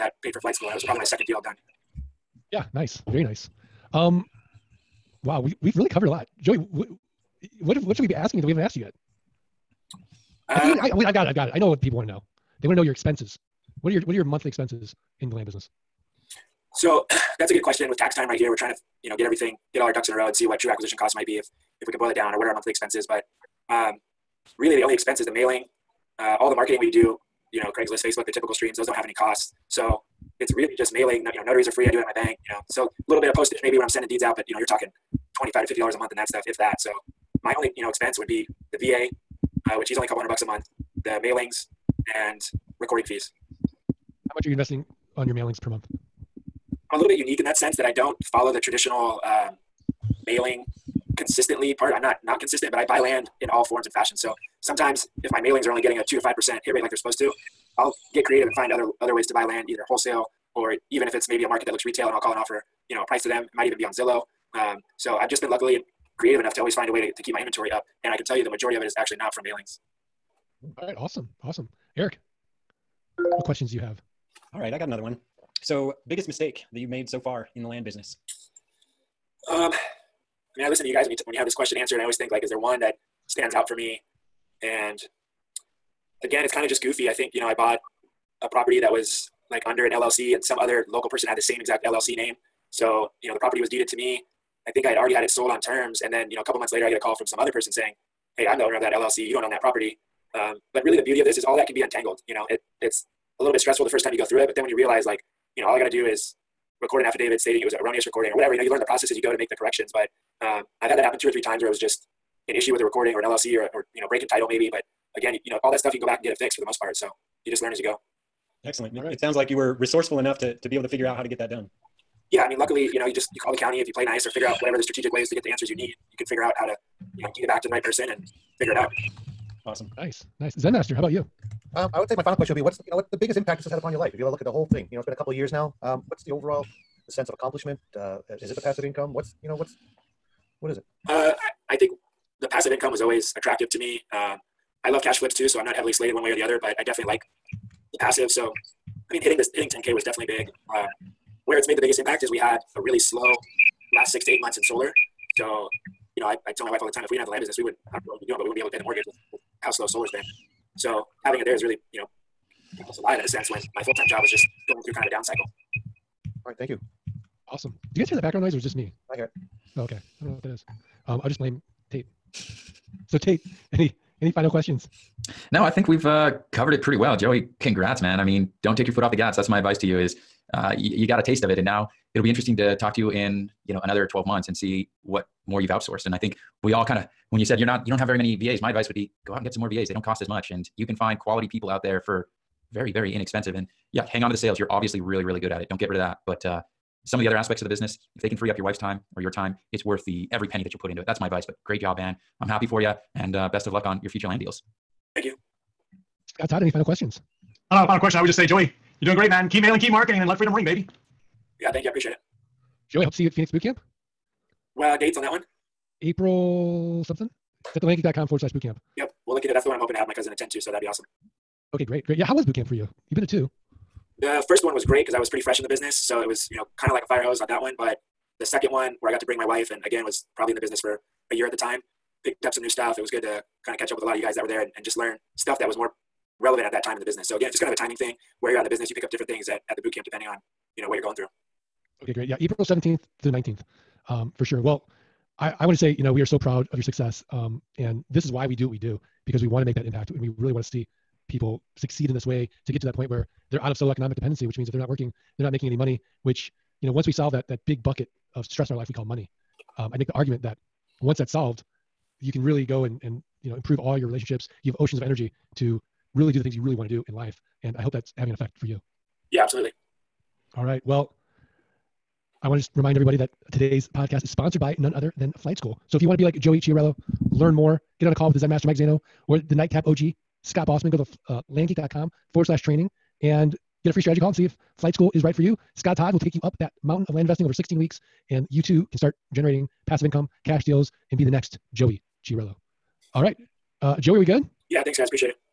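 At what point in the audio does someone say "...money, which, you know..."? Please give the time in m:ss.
4:15.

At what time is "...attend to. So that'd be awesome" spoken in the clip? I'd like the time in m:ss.
3:40.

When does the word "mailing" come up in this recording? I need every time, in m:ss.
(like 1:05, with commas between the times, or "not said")
0:25, 0:30, 0:41, 0:45, 0:50, 0:55, 1:09, 3:29.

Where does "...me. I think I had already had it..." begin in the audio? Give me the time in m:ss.
1:33.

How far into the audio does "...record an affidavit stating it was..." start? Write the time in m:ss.
1:46.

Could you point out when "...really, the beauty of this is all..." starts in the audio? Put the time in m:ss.
1:40.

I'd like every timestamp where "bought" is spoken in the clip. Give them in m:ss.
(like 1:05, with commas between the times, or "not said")
1:27.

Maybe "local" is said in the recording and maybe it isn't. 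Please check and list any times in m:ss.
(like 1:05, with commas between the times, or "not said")
1:30.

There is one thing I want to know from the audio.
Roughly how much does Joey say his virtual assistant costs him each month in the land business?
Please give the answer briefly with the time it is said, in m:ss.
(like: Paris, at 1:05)
a couple hundred bucks, at 0:40.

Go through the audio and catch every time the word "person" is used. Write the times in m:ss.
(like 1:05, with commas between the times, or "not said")
1:31, 1:37, 2:07.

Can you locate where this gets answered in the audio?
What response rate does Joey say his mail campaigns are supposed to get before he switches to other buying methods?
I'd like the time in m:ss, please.
0:56.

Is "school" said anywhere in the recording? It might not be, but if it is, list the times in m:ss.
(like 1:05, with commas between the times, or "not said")
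0:00, 4:35, 4:44.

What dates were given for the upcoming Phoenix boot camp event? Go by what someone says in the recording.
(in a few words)
April 17th to 19th.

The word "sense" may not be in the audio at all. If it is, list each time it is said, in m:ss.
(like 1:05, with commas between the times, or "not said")
0:47, 2:17, 2:43.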